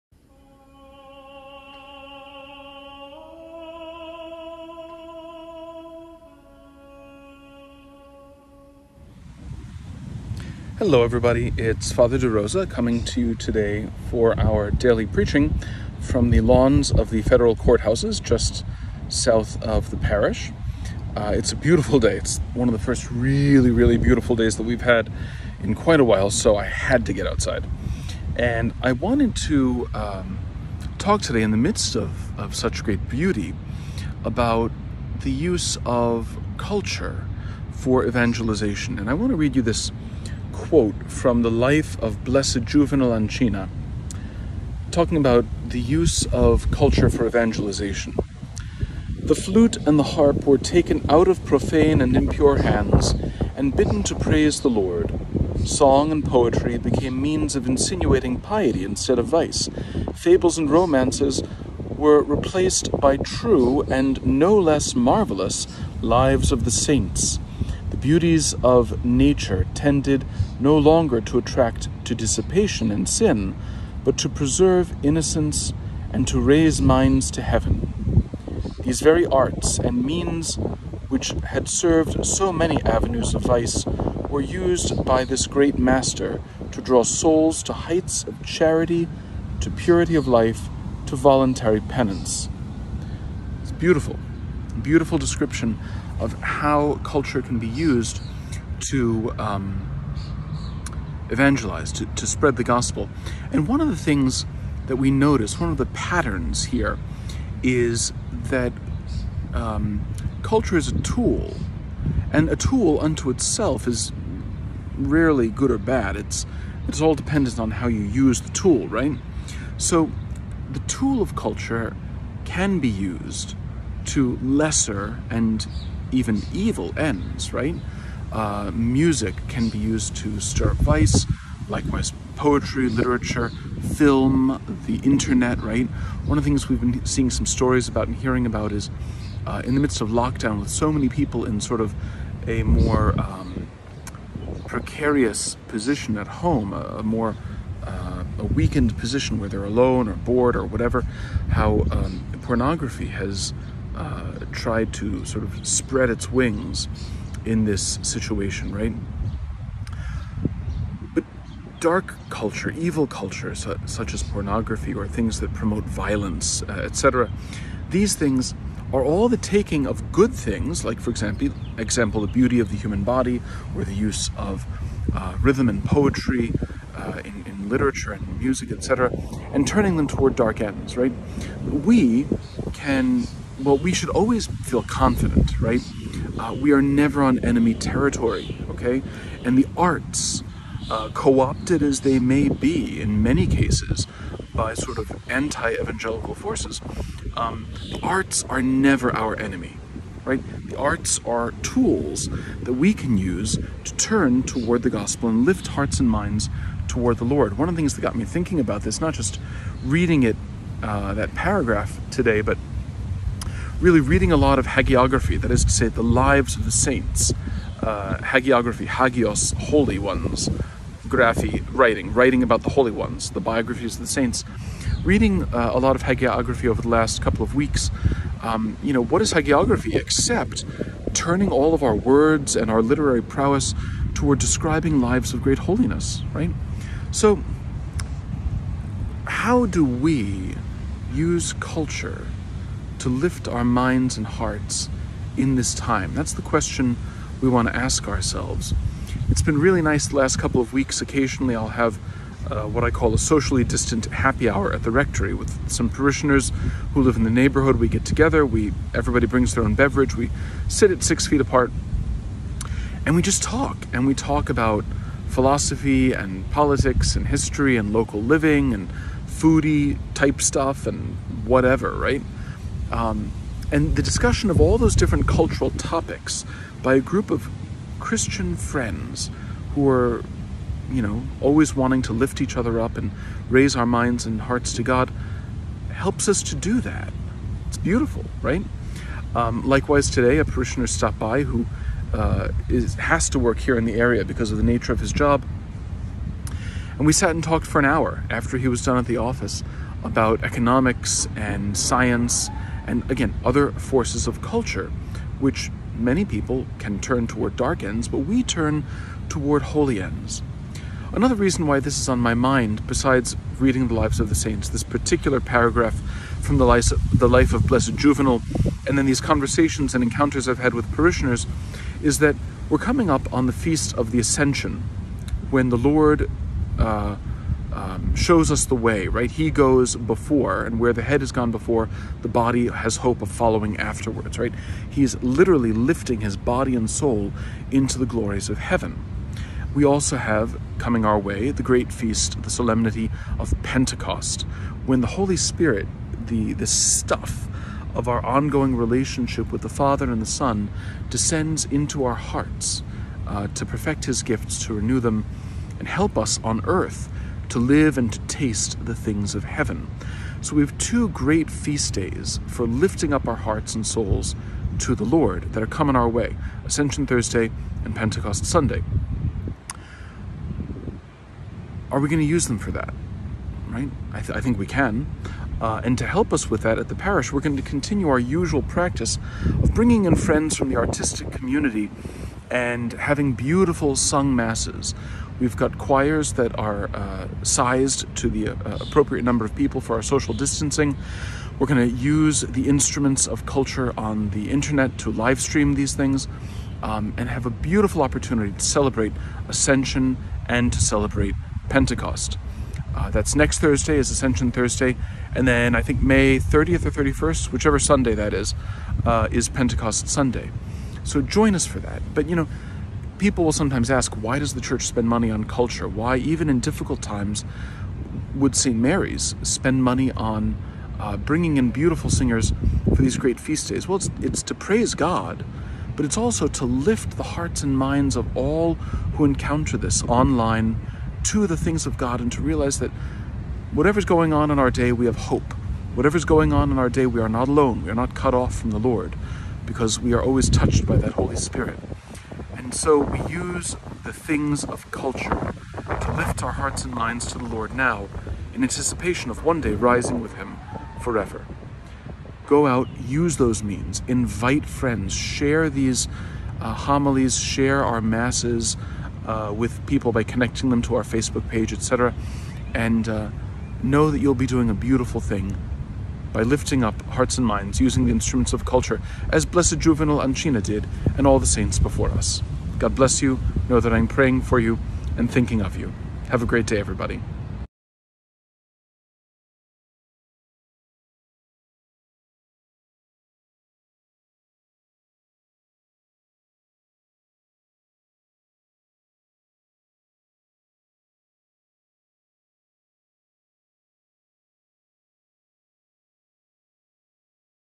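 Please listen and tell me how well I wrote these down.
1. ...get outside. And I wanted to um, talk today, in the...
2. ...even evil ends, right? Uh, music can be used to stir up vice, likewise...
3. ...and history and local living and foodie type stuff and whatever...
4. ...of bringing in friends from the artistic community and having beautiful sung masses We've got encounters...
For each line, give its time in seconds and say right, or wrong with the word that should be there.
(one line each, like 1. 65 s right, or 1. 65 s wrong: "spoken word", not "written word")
1. 27 s right
2. 126 s right
3. 267 s right
4. 379 s wrong: "choirs", not "encounters".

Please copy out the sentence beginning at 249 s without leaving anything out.
It's been really nice the last couple of weeks.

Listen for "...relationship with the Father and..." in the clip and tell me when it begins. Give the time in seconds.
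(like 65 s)
348 s.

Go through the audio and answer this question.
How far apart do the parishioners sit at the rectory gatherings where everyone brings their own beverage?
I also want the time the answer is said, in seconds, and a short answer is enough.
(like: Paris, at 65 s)
6 feet, at 261 s.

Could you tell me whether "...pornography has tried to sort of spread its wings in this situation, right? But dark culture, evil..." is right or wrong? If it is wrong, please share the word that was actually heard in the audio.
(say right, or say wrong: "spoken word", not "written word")
right.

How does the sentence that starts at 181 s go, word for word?
We can well, we should always feel confident, right?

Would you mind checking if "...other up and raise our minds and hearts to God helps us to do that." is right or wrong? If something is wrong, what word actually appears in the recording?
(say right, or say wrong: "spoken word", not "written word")
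right.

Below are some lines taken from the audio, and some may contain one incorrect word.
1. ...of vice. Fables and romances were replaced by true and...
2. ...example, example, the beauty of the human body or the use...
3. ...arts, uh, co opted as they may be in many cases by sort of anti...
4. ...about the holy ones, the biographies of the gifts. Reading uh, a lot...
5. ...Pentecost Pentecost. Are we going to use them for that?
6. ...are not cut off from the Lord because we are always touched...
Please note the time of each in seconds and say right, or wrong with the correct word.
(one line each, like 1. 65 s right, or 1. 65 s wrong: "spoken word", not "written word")
1. 59 s right
2. 171 s right
3. 189 s right
4. 222 s wrong: "saints", not "gifts"
5. 367 s wrong: "Sunday", not "Pentecost"
6. 437 s right.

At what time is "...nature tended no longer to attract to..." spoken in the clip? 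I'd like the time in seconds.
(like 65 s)
69 s.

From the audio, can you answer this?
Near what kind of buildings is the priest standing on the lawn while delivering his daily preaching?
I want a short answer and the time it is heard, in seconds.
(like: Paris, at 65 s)
Federal courthouses, at 17 s.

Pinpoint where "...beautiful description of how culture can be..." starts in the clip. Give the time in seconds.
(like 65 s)
94 s.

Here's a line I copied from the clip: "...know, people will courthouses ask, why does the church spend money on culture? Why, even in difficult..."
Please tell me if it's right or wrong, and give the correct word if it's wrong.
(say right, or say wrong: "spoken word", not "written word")
wrong: "sometimes", not "courthouses".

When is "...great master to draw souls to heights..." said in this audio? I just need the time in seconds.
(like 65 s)
85 s.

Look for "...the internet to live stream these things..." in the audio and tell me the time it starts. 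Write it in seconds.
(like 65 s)
394 s.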